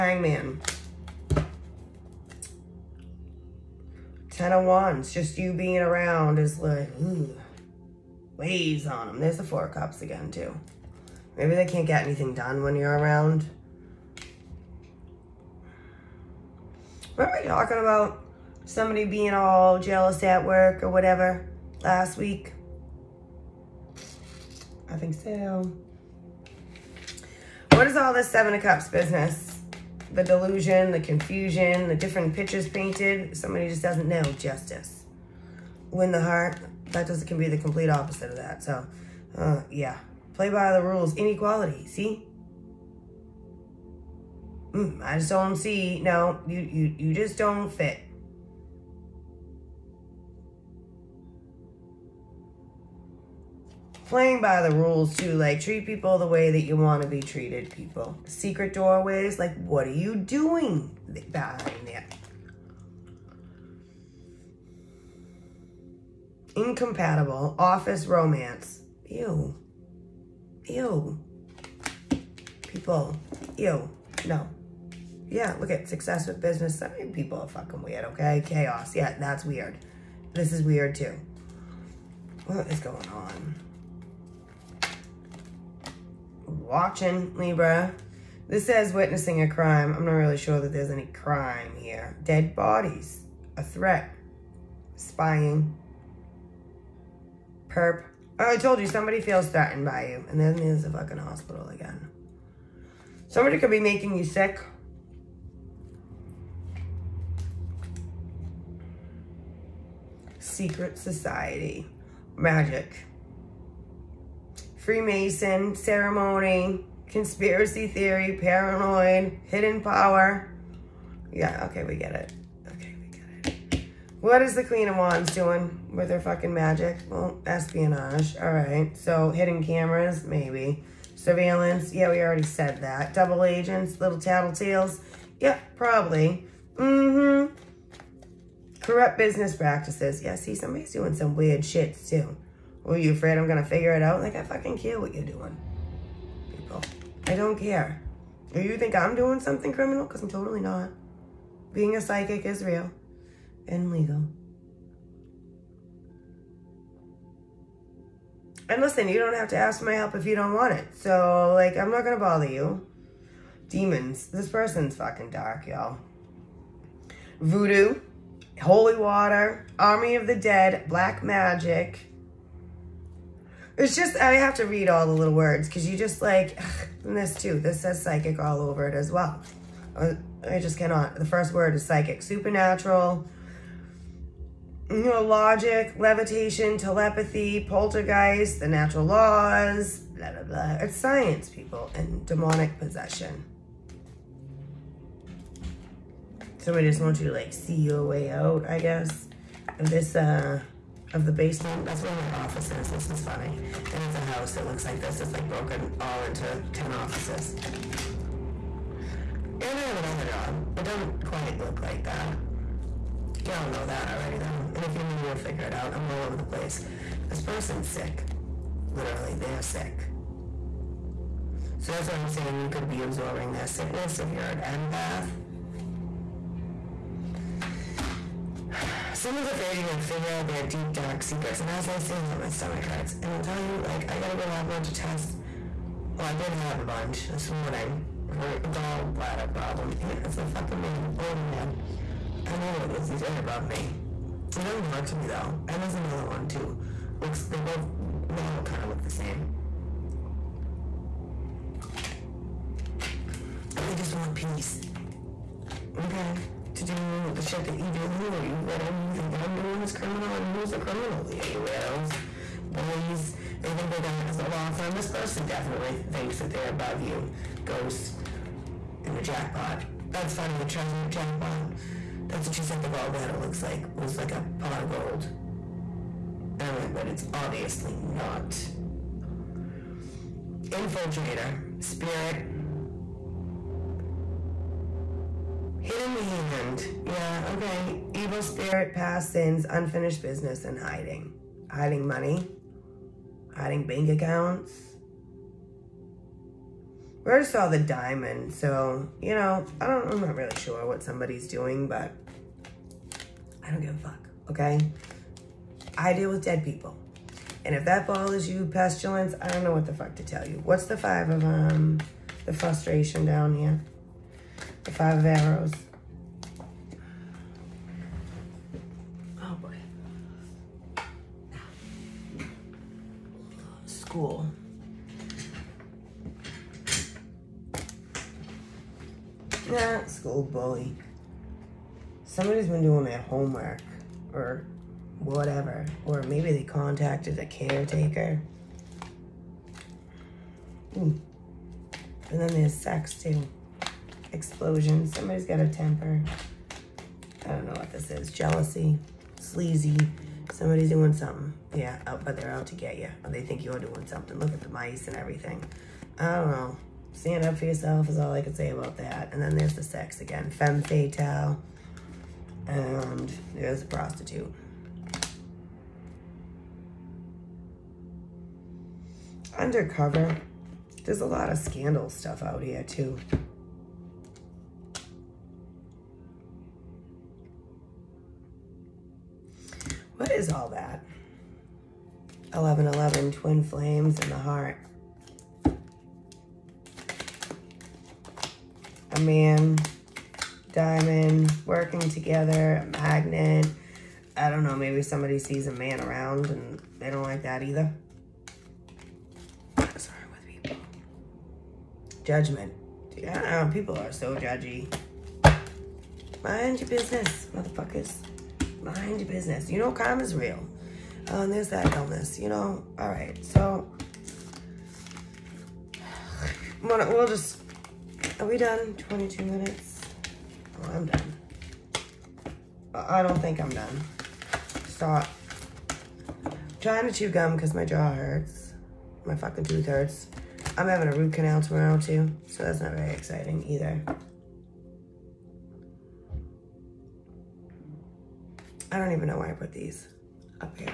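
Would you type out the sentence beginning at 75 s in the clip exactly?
Yeah, look at success with business.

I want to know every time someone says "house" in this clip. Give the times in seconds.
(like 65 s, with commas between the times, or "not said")
204 s.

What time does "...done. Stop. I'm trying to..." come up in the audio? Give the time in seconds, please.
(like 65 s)
423 s.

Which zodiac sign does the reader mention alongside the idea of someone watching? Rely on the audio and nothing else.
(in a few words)
Libra.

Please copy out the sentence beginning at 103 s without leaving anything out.
Somebody could be making you sick.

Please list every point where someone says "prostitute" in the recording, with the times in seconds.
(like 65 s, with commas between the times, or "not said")
363 s.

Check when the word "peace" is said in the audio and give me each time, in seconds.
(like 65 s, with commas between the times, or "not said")
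254 s.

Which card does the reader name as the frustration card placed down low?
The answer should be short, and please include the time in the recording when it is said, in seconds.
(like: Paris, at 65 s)
Five of arrows, at 314 s.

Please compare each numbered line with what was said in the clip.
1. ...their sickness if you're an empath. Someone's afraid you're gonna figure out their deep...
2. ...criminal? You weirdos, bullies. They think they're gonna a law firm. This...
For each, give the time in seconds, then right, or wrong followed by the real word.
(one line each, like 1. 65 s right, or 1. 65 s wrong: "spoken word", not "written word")
1. 223 s right
2. 260 s right.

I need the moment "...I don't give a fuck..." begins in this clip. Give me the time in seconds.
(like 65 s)
303 s.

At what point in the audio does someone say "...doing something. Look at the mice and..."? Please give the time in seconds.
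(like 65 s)
353 s.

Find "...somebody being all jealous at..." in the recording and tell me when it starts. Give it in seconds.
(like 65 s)
18 s.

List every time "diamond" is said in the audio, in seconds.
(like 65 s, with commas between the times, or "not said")
297 s, 390 s.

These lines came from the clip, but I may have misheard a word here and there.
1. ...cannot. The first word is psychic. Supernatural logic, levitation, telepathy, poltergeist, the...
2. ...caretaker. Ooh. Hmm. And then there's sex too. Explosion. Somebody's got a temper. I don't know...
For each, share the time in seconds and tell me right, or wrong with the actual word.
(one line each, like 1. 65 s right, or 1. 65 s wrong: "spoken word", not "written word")
1. 180 s right
2. 337 s right.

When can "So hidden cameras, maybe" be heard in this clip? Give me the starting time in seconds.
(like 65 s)
128 s.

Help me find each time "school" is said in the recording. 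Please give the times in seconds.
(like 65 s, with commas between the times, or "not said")
323 s, 330 s.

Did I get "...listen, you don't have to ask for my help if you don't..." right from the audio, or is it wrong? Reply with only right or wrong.
right.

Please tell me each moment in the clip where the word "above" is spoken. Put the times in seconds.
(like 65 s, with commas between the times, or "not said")
243 s, 266 s.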